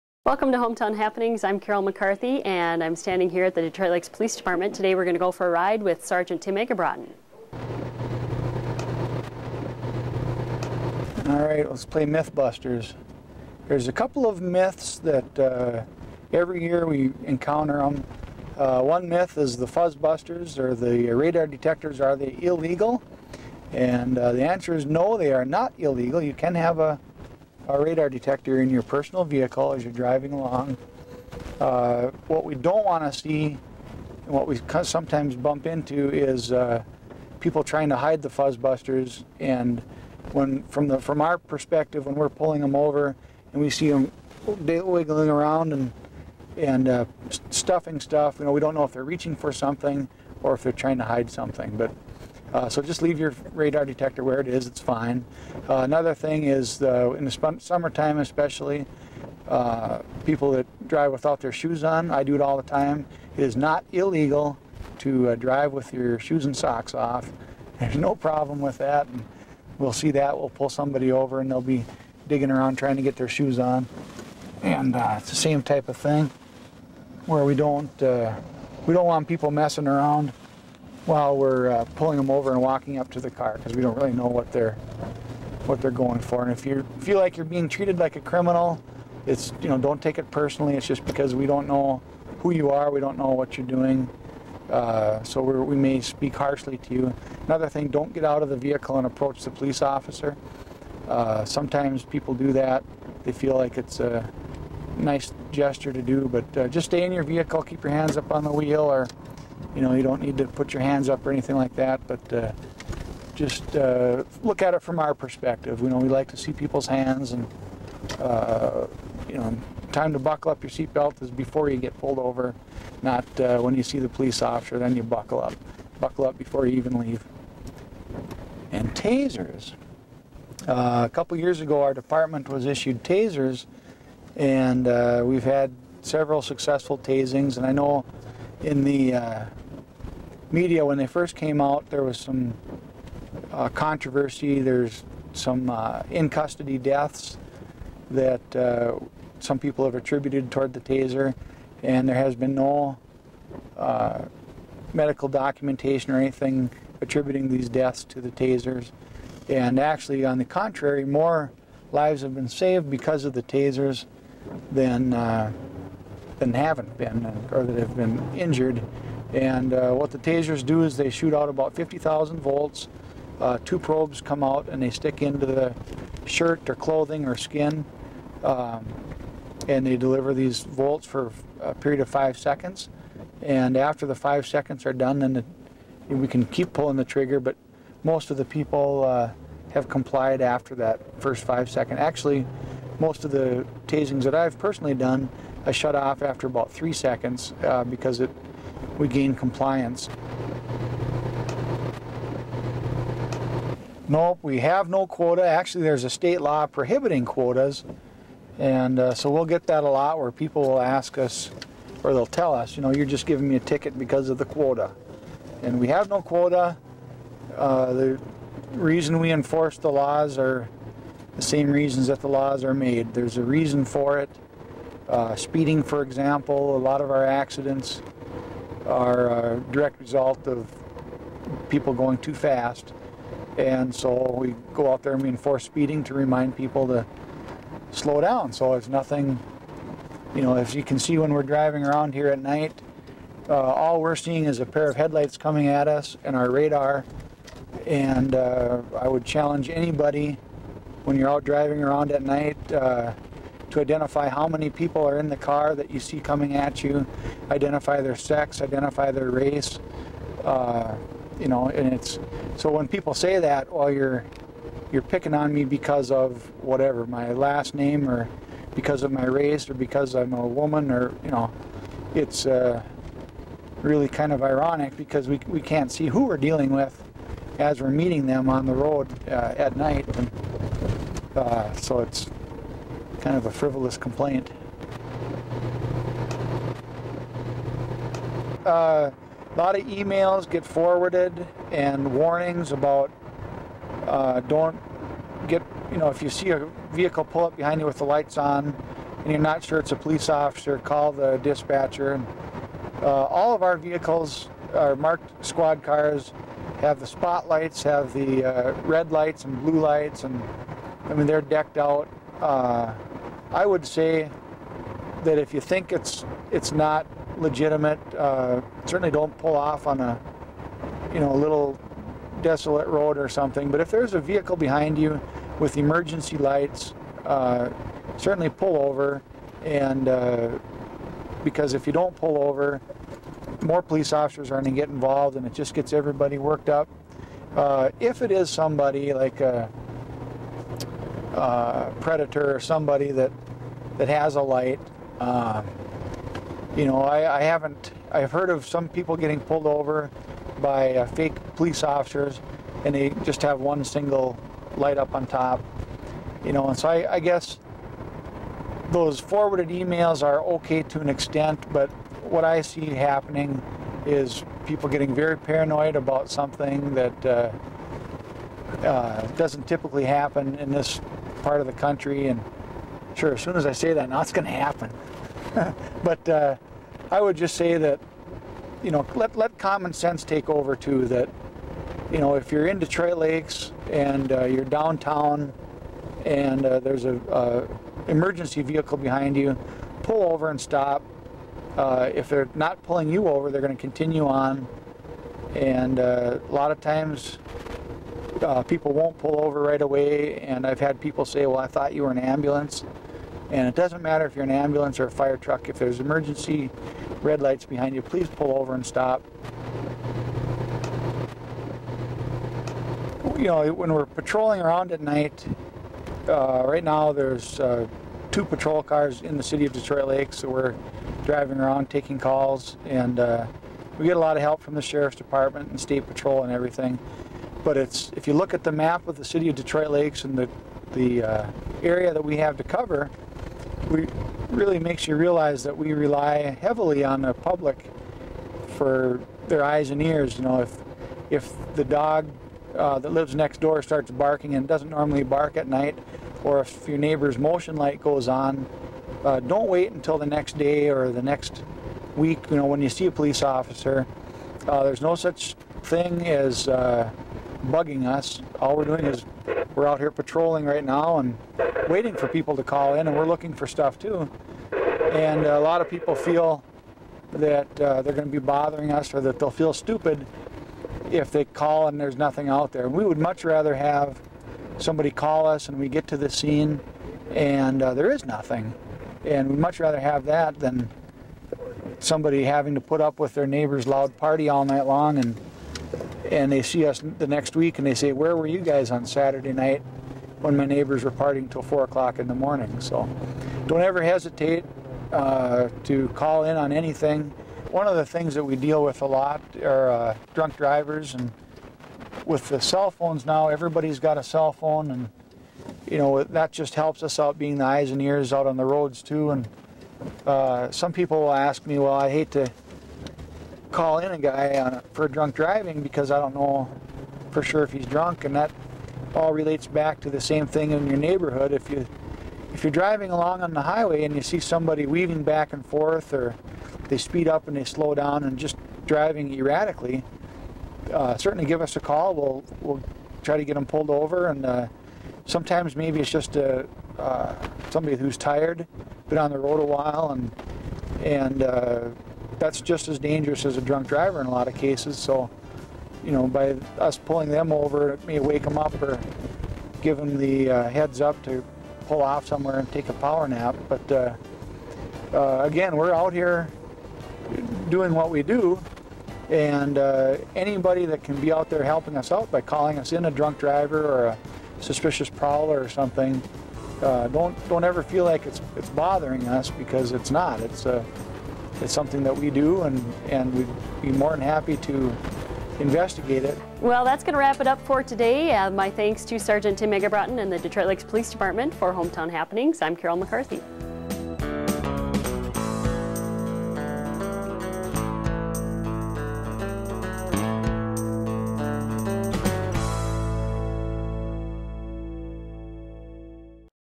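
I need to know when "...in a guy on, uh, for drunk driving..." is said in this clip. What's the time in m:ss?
8:33.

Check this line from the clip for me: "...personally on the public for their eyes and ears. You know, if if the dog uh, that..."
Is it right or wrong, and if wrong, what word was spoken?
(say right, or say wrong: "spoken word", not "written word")
wrong: "heavily", not "personally".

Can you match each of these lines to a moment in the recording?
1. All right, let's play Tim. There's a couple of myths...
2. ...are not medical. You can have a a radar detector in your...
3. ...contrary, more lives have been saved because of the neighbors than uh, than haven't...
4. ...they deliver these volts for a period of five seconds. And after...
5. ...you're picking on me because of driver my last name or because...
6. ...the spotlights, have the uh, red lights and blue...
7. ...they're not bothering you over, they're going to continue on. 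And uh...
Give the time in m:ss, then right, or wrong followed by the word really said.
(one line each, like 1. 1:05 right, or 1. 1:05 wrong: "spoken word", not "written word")
1. 0:11 wrong: "Mythbusters", not "Tim"
2. 0:25 wrong: "illegal", not "medical"
3. 2:40 wrong: "tasers", not "neighbors"
4. 2:59 right
5. 4:24 wrong: "whatever", not "driver"
6. 5:06 right
7. 6:32 wrong: "pulling", not "bothering".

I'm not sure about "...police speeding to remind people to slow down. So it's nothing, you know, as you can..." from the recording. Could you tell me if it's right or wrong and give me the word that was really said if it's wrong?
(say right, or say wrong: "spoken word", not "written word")
wrong: "enforce", not "police".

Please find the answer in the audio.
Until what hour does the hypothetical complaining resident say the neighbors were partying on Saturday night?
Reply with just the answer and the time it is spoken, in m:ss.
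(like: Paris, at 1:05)
4 o'clock, at 8:11.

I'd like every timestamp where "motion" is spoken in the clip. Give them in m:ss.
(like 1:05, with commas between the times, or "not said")
7:27.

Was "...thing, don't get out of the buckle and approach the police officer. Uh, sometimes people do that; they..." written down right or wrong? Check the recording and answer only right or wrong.
wrong.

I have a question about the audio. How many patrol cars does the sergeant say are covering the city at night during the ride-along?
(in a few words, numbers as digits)
2.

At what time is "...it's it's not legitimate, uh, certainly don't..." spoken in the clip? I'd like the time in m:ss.
5:15.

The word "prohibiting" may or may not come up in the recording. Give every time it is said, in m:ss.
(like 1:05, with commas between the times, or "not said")
3:26.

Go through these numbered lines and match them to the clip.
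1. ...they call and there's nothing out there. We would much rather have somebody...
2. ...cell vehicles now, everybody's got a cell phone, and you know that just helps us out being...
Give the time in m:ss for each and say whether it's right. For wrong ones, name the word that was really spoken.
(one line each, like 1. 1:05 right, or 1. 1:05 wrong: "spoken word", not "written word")
1. 7:51 right
2. 8:22 wrong: "phones", not "vehicles".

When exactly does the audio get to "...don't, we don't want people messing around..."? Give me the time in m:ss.
1:17.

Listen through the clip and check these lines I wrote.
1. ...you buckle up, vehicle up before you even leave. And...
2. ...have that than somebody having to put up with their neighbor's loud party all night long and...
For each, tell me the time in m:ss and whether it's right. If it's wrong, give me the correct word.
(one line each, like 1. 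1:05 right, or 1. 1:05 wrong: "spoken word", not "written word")
1. 2:04 wrong: "buckle", not "vehicle"
2. 7:59 right.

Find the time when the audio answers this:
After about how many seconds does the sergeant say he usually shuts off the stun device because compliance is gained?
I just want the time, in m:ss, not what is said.
3:16.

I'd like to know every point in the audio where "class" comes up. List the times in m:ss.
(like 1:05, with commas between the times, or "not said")
not said.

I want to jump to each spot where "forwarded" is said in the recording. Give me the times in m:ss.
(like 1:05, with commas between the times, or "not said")
4:50, 5:59.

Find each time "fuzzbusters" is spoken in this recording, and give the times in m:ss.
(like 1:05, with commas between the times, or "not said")
0:19, 0:38.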